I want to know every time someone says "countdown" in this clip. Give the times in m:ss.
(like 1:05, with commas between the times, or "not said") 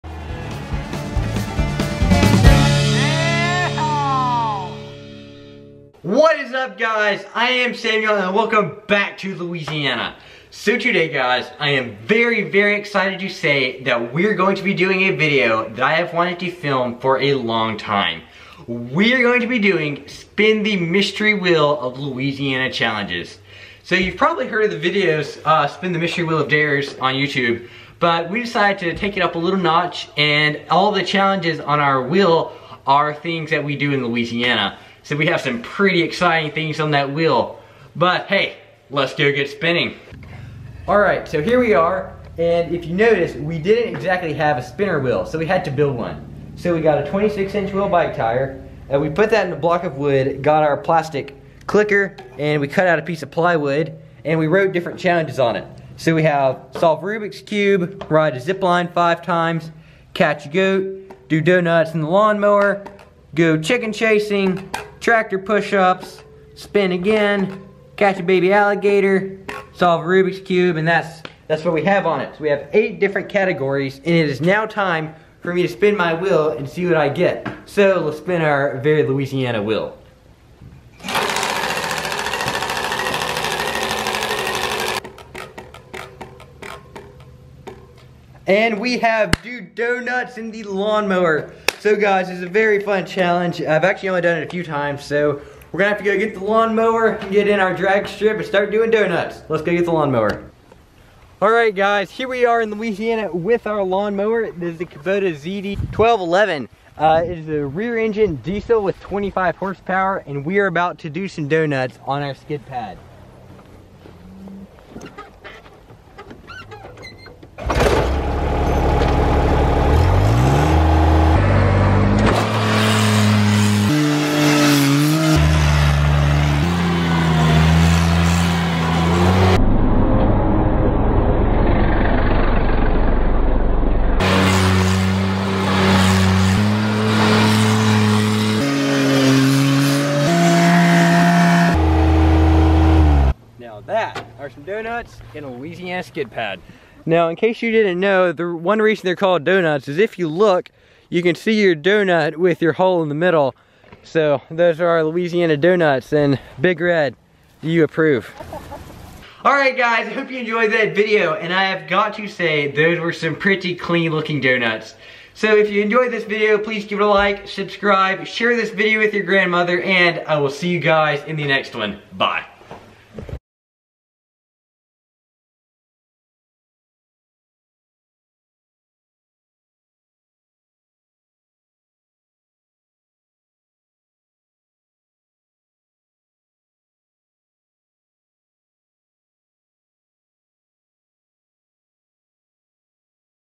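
not said.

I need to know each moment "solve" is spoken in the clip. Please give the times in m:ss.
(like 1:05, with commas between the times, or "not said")
0:56, 1:09.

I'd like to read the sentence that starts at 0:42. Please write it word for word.
And if you notice, we didn't exactly have a spinner wheel, so we had to build one.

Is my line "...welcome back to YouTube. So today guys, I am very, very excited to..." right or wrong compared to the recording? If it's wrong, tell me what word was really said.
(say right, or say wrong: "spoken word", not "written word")
wrong: "Louisiana", not "YouTube".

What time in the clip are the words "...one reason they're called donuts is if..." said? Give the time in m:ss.
2:28.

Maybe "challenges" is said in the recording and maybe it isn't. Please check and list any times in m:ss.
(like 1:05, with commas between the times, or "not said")
0:22, 0:31, 0:54, 1:33.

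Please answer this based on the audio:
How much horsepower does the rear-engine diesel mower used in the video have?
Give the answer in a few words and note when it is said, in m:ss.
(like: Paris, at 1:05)
25, at 1:48.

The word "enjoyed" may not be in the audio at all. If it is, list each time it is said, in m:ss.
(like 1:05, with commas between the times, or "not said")
2:40, 2:45.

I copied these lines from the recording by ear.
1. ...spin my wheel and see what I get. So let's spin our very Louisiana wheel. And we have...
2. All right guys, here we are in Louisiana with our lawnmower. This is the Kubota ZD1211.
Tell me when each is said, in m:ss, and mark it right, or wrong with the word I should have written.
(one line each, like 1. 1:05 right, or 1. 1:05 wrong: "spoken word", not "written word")
1. 1:15 right
2. 1:41 right.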